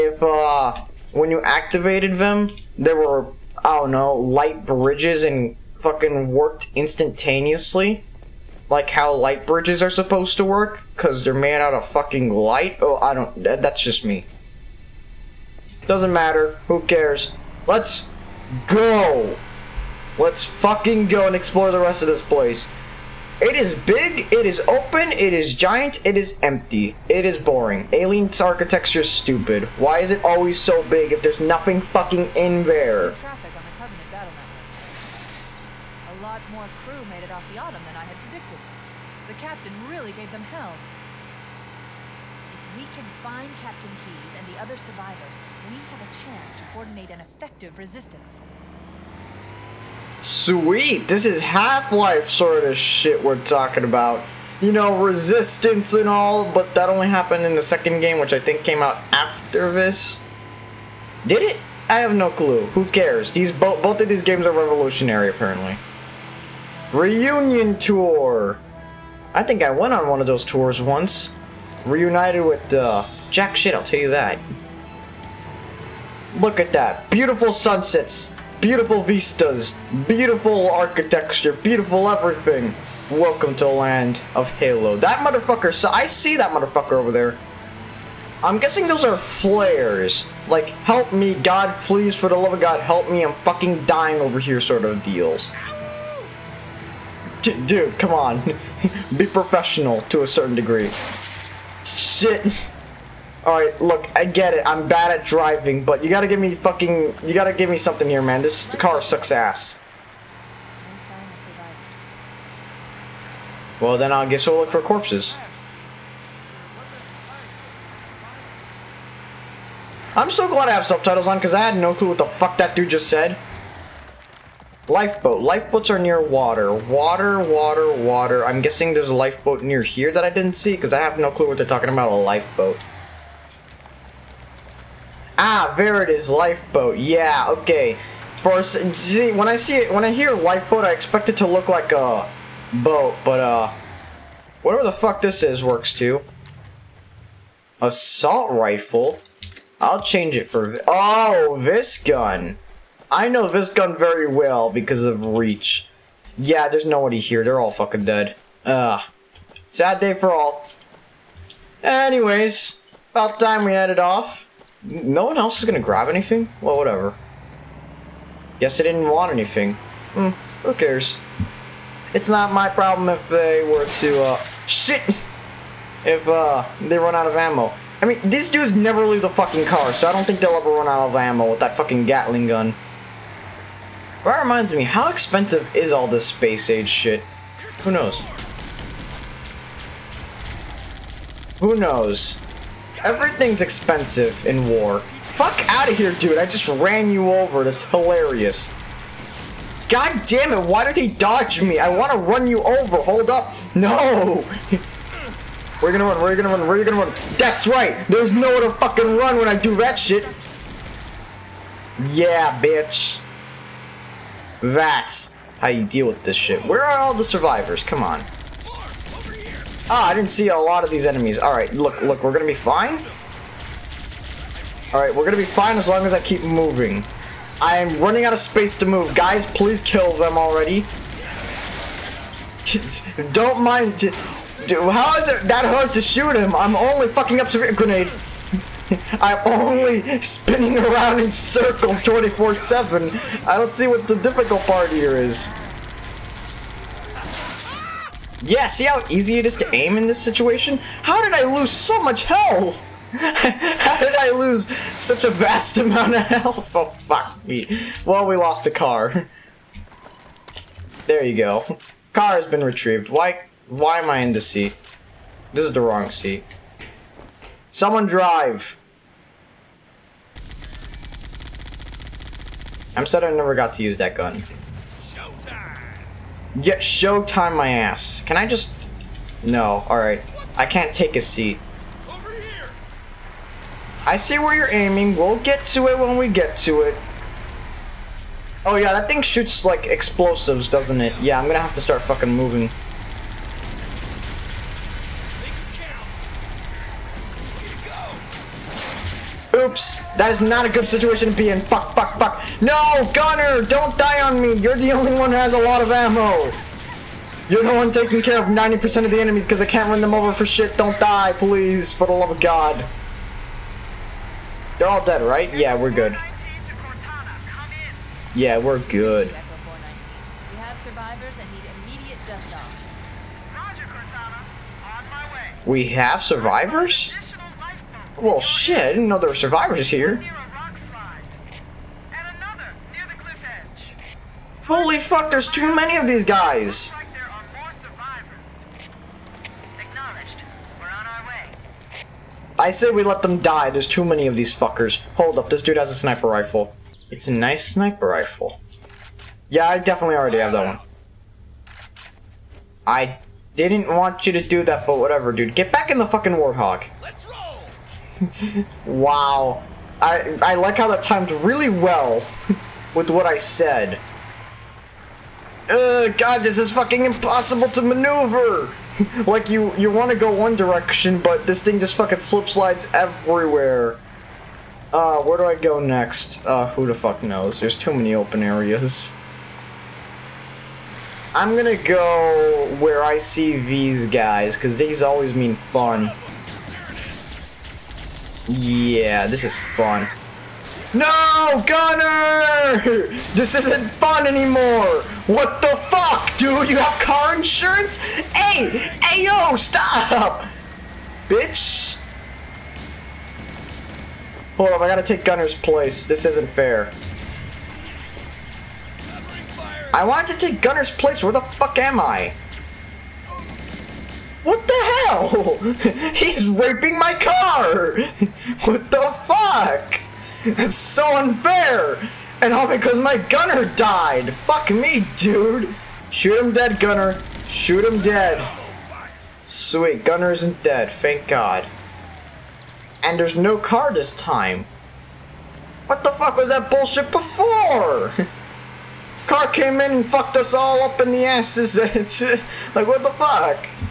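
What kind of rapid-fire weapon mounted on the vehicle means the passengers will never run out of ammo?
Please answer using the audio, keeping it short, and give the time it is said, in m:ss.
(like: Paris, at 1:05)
Gatling gun, at 3:02.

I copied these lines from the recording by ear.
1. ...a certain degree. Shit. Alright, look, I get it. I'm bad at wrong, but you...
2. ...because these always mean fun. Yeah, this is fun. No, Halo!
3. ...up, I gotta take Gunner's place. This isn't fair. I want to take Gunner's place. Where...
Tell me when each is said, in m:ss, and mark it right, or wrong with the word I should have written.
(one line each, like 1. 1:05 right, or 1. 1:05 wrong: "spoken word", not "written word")
1. 1:40 wrong: "driving", not "wrong"
2. 6:24 wrong: "Gunner", not "Halo"
3. 6:44 right.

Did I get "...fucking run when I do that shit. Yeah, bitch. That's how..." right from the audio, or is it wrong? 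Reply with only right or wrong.
right.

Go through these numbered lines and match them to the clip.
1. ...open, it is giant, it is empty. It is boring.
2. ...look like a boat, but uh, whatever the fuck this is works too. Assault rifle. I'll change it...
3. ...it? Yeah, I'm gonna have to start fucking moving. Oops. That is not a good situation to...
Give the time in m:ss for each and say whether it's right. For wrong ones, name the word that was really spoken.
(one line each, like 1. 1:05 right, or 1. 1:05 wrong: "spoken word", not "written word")
1. 0:24 right
2. 2:21 right
3. 4:51 right.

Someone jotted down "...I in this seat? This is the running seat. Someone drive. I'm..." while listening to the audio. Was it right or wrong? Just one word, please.
wrong.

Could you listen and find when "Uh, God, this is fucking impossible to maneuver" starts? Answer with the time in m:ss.
6:05.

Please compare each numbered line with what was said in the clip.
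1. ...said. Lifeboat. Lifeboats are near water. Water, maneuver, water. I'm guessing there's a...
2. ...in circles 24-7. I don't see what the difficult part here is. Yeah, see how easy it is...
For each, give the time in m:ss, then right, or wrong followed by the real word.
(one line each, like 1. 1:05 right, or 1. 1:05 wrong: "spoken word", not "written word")
1. 2:03 wrong: "water", not "maneuver"
2. 4:01 right.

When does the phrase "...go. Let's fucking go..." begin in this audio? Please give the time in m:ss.
0:18.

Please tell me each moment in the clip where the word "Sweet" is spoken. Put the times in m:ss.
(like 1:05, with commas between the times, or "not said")
0:50, 7:09.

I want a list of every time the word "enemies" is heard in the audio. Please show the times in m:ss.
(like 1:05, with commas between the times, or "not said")
3:41, 5:09.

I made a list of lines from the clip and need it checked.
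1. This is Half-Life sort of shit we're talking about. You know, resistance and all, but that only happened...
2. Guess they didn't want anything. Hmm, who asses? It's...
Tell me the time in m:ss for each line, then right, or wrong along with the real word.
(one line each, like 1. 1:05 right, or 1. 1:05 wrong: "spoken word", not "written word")
1. 0:51 right
2. 2:48 wrong: "cares", not "asses".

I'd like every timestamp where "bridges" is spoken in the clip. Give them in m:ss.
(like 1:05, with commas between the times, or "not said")
0:04, 0:09.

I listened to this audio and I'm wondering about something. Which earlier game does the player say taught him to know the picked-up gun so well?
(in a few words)
Reach.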